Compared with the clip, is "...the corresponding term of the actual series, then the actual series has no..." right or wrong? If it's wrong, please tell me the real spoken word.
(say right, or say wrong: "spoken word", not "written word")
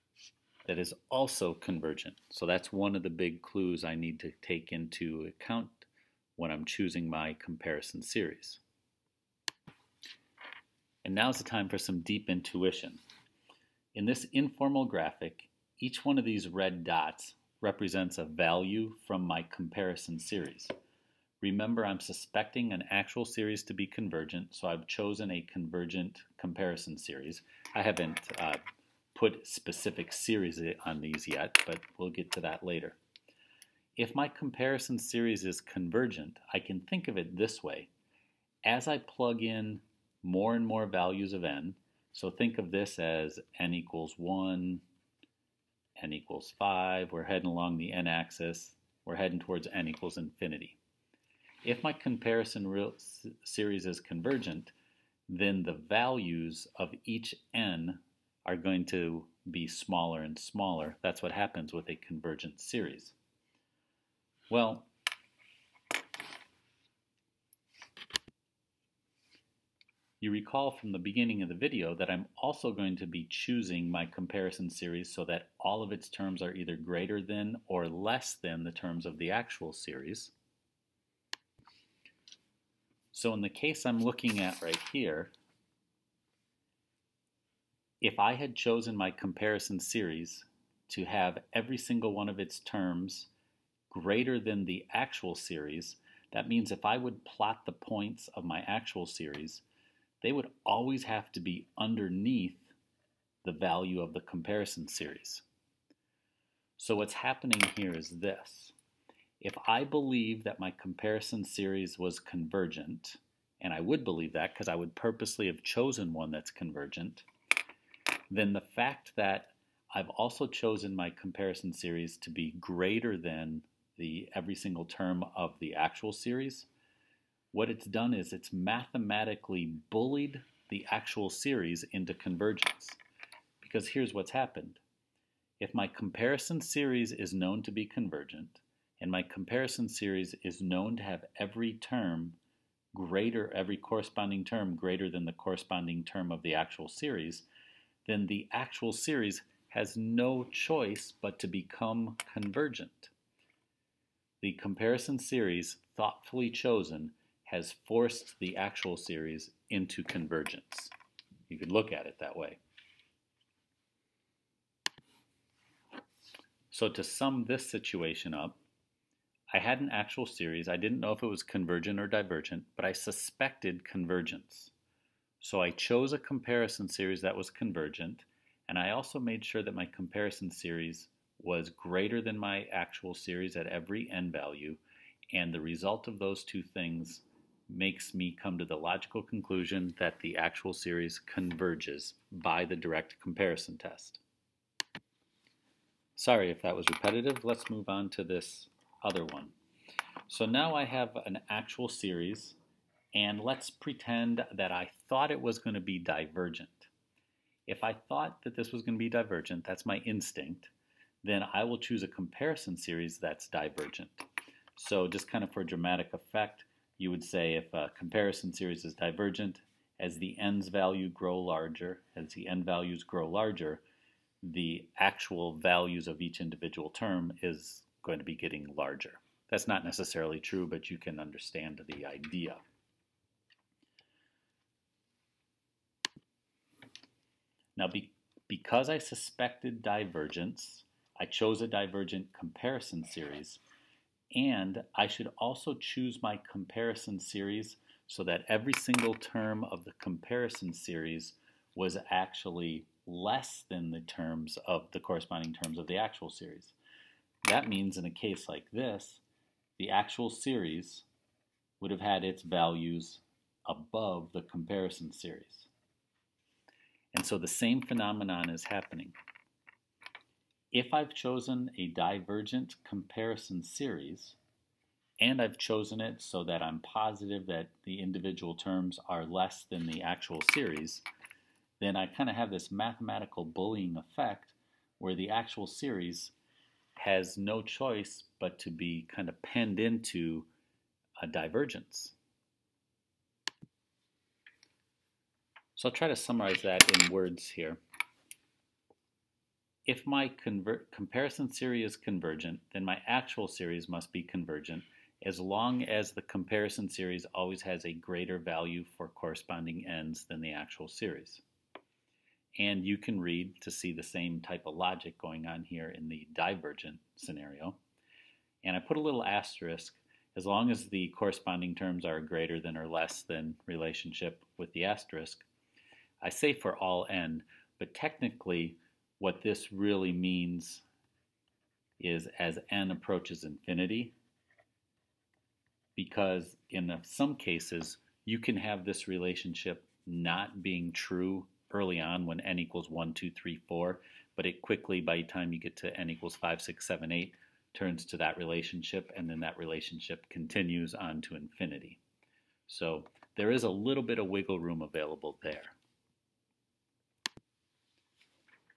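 right.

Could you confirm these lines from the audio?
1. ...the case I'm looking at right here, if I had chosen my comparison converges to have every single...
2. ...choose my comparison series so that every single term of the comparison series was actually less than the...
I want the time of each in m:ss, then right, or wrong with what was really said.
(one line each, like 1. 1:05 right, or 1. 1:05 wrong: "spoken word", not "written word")
1. 1:23 wrong: "series", not "converges"
2. 4:05 right.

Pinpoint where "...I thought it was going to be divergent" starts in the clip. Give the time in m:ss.
3:24.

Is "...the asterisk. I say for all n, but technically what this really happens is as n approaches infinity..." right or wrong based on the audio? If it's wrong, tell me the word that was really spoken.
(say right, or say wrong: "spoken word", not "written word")
wrong: "means", not "happens".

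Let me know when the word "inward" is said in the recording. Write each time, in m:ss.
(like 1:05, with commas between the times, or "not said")
not said.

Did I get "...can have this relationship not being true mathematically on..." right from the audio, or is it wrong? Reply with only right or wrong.
wrong.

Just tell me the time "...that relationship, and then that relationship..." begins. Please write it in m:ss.
5:48.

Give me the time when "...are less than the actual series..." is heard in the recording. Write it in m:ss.
4:39.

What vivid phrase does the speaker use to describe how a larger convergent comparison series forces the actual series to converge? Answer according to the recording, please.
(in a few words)
mathematically bullied.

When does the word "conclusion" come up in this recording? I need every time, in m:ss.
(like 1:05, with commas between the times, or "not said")
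3:09.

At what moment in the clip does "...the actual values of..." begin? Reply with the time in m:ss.
3:44.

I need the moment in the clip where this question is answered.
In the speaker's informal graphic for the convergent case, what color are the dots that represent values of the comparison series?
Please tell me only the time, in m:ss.
0:16.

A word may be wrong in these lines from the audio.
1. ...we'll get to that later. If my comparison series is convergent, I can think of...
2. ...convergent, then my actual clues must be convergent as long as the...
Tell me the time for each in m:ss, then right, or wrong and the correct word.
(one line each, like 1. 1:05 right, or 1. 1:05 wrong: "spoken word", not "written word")
1. 0:31 right
2. 5:01 wrong: "series", not "clues".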